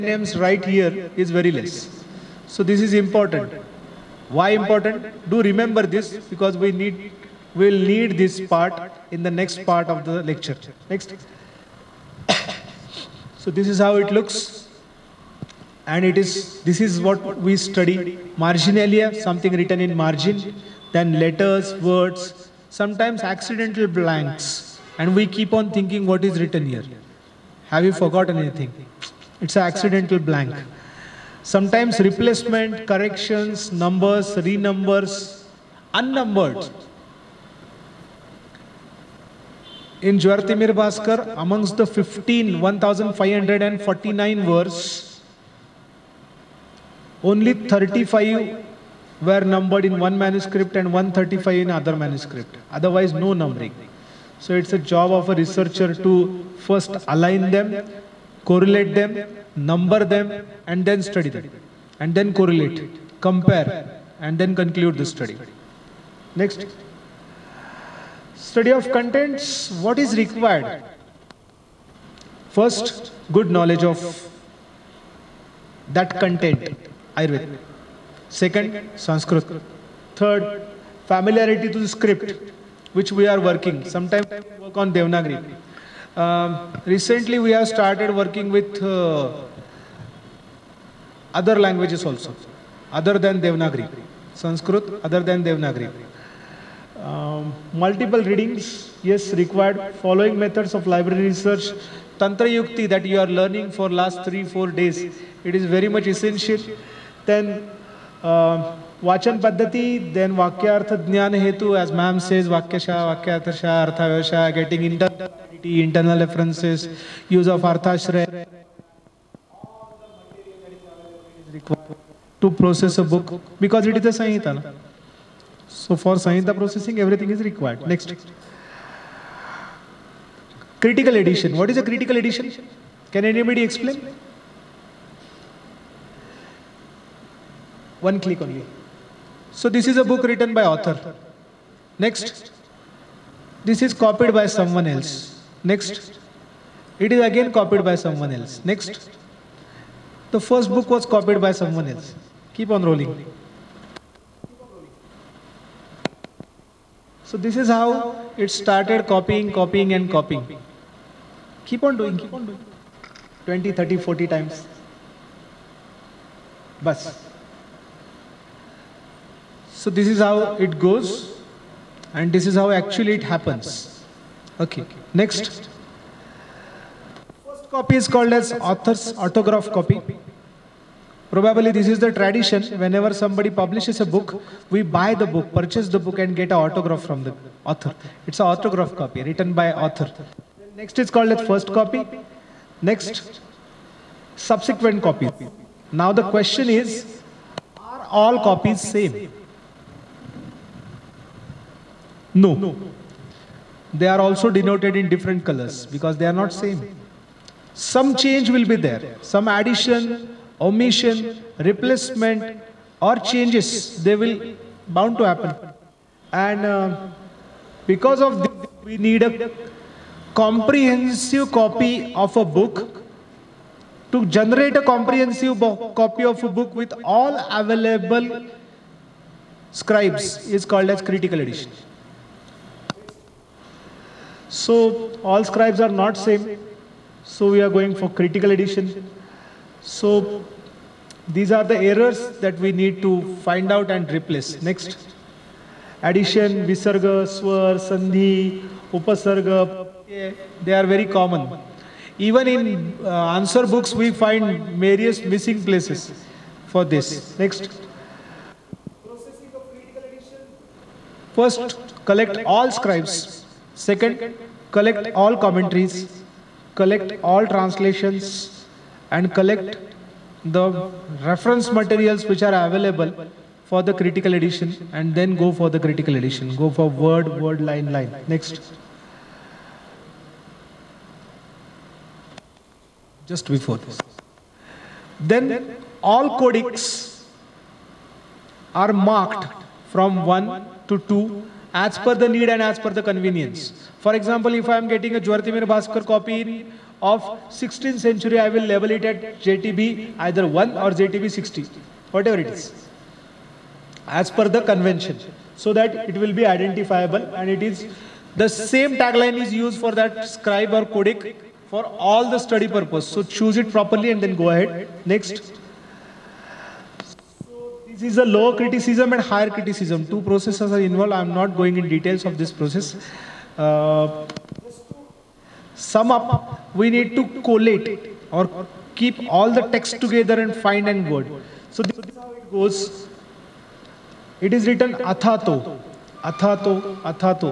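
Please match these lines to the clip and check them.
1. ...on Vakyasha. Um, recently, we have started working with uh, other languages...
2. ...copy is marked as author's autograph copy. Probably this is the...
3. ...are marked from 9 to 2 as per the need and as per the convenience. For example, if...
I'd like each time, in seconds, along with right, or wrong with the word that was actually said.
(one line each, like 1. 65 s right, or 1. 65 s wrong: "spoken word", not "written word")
1. 84 s wrong: "Devanagari", not "Vakyasha"
2. 177 s wrong: "called", not "marked"
3. 288 s wrong: "1", not "9".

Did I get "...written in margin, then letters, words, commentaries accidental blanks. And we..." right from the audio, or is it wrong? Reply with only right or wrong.
wrong.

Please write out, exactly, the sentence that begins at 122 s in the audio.
To process a book, because it is a Sanhita.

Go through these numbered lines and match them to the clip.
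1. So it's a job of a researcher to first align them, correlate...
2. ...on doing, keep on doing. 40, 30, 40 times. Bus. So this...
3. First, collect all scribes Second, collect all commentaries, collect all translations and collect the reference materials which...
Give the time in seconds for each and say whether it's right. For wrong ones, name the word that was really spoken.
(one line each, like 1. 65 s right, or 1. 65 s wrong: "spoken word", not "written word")
1. 54 s right
2. 161 s wrong: "20", not "40"
3. 261 s right.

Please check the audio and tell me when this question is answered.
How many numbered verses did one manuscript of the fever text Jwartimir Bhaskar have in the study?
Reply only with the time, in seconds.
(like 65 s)
47 s.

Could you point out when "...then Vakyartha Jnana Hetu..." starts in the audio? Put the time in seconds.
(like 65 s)
110 s.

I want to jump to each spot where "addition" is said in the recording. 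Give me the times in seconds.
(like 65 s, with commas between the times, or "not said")
209 s, 246 s.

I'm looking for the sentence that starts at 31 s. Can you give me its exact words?
Sometimes replacement, corrections, numbers, renumbers, unnumbered.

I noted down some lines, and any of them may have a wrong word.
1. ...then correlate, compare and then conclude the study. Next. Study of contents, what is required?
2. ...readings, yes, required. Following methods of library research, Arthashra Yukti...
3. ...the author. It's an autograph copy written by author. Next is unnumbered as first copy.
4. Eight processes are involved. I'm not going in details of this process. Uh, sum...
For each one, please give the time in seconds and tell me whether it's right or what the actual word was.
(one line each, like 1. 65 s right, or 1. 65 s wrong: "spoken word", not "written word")
1. 62 s right
2. 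98 s wrong: "Tantra", not "Arthashra"
3. 187 s wrong: "called", not "unnumbered"
4. 320 s wrong: "Two", not "Eight".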